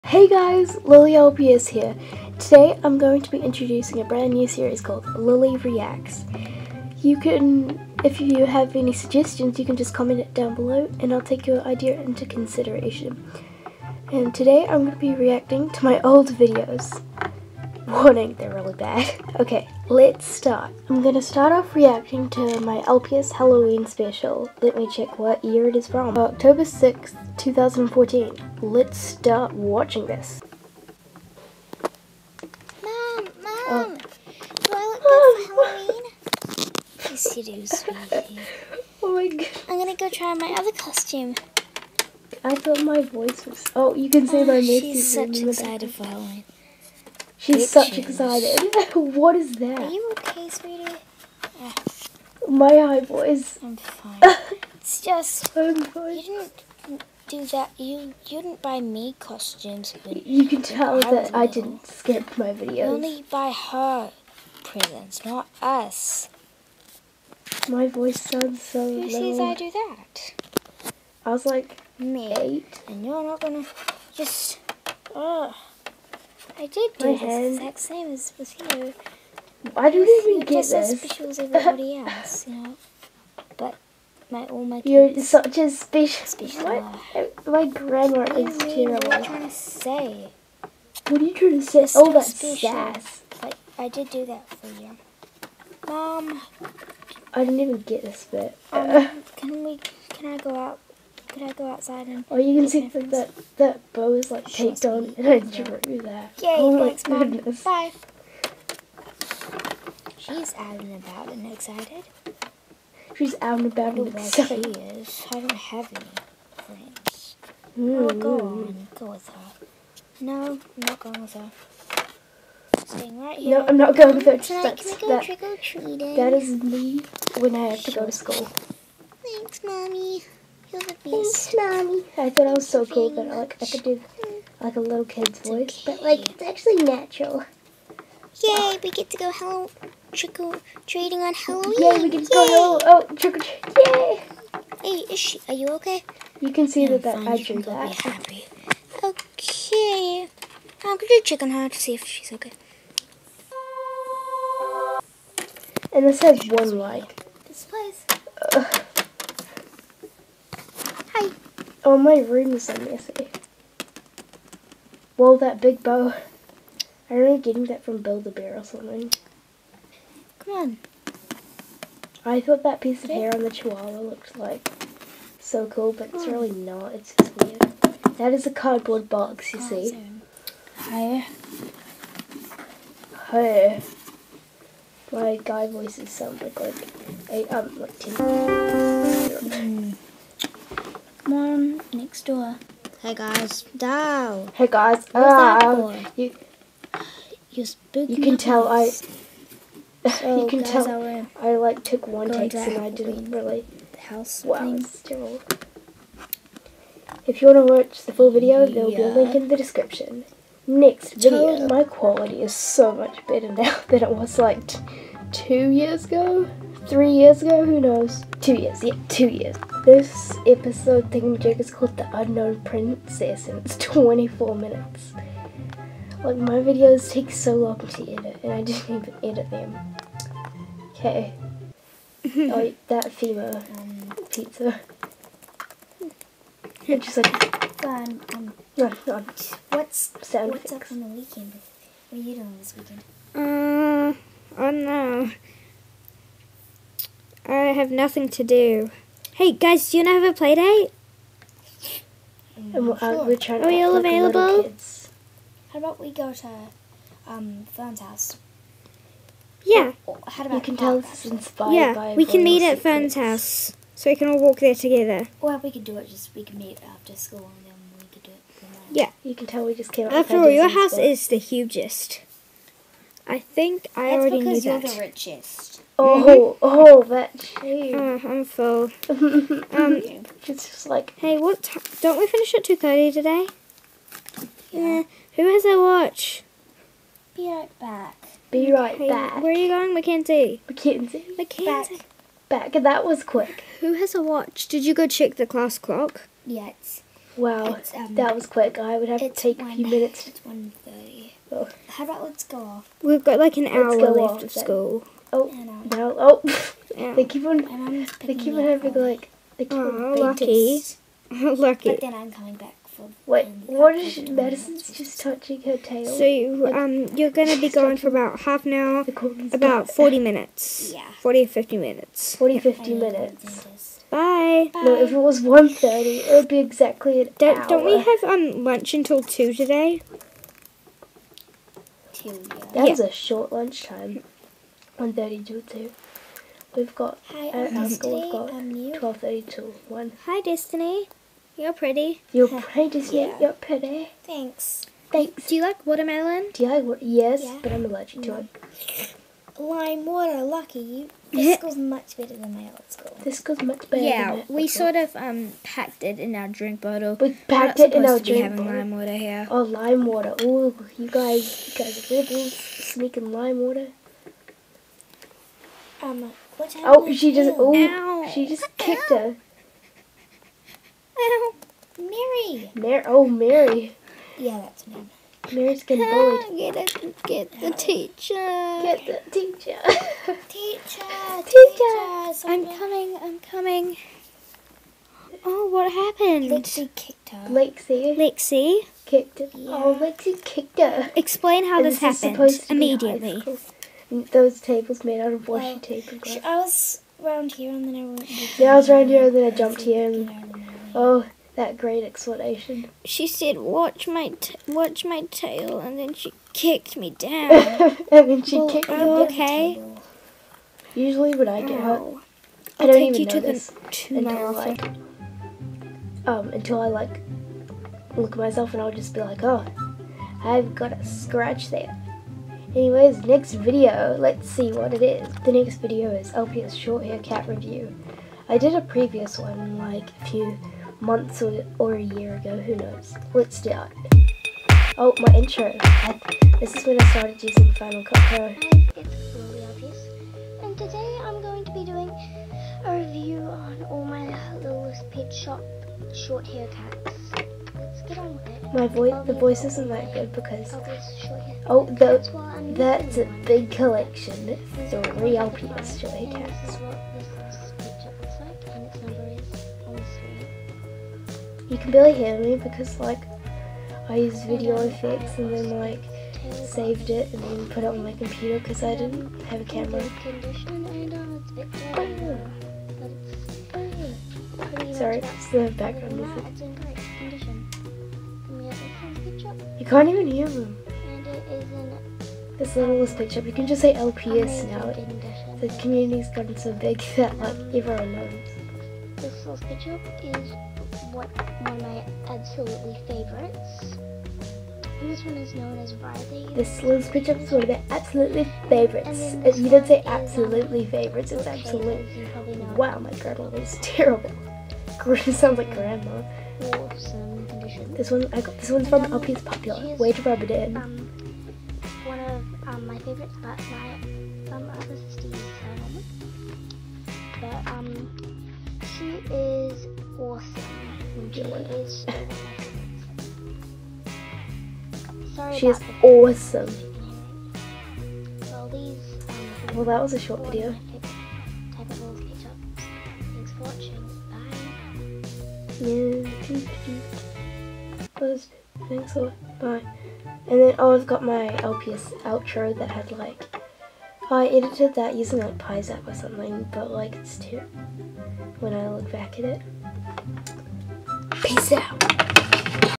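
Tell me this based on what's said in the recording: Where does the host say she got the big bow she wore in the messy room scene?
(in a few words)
Build-A-Bear.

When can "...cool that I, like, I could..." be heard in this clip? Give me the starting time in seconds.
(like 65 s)
132 s.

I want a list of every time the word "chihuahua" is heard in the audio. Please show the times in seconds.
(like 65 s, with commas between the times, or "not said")
173 s.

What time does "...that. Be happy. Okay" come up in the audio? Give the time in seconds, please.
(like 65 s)
147 s.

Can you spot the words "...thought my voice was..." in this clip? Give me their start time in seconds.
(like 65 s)
42 s.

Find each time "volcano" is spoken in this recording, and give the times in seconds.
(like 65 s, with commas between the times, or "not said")
not said.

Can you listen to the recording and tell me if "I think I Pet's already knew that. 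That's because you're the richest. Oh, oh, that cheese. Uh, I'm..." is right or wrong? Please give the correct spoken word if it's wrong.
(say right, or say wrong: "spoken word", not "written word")
wrong: "That", not "Pet".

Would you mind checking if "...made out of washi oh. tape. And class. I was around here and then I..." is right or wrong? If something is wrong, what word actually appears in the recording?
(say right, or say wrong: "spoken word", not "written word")
wrong: "glass", not "class".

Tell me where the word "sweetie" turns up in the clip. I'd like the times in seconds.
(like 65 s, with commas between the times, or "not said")
37 s, 50 s.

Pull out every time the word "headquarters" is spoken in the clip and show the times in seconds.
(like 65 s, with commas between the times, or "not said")
not said.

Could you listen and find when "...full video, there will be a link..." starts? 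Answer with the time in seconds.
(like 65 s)
208 s.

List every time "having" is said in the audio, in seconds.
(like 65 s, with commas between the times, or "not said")
308 s, 358 s.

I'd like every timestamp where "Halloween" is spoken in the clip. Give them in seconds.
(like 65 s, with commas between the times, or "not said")
23 s, 36 s, 46 s, 141 s.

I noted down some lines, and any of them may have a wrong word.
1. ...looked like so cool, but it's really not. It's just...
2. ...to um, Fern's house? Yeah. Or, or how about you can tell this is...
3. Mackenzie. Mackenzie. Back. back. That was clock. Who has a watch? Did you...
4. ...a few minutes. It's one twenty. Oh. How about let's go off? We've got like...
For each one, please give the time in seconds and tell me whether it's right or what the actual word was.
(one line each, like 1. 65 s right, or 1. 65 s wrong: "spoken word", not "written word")
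1. 173 s right
2. 256 s right
3. 290 s wrong: "quick", not "clock"
4. 299 s wrong: "thirty", not "twenty".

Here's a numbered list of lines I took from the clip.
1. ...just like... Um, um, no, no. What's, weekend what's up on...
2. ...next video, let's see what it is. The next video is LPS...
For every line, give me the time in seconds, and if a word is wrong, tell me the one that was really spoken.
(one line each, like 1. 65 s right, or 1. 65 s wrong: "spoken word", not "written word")
1. 237 s wrong: "sound", not "weekend"
2. 423 s right.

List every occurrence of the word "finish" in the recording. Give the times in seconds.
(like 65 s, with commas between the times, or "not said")
282 s.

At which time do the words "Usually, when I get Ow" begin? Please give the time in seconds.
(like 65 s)
410 s.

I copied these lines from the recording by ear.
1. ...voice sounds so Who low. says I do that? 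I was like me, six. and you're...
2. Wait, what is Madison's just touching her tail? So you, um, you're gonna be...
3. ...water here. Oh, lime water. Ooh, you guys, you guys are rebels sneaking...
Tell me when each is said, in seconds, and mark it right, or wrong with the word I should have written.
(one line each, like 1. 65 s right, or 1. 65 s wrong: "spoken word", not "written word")
1. 67 s wrong: "eight", not "six"
2. 313 s right
3. 358 s right.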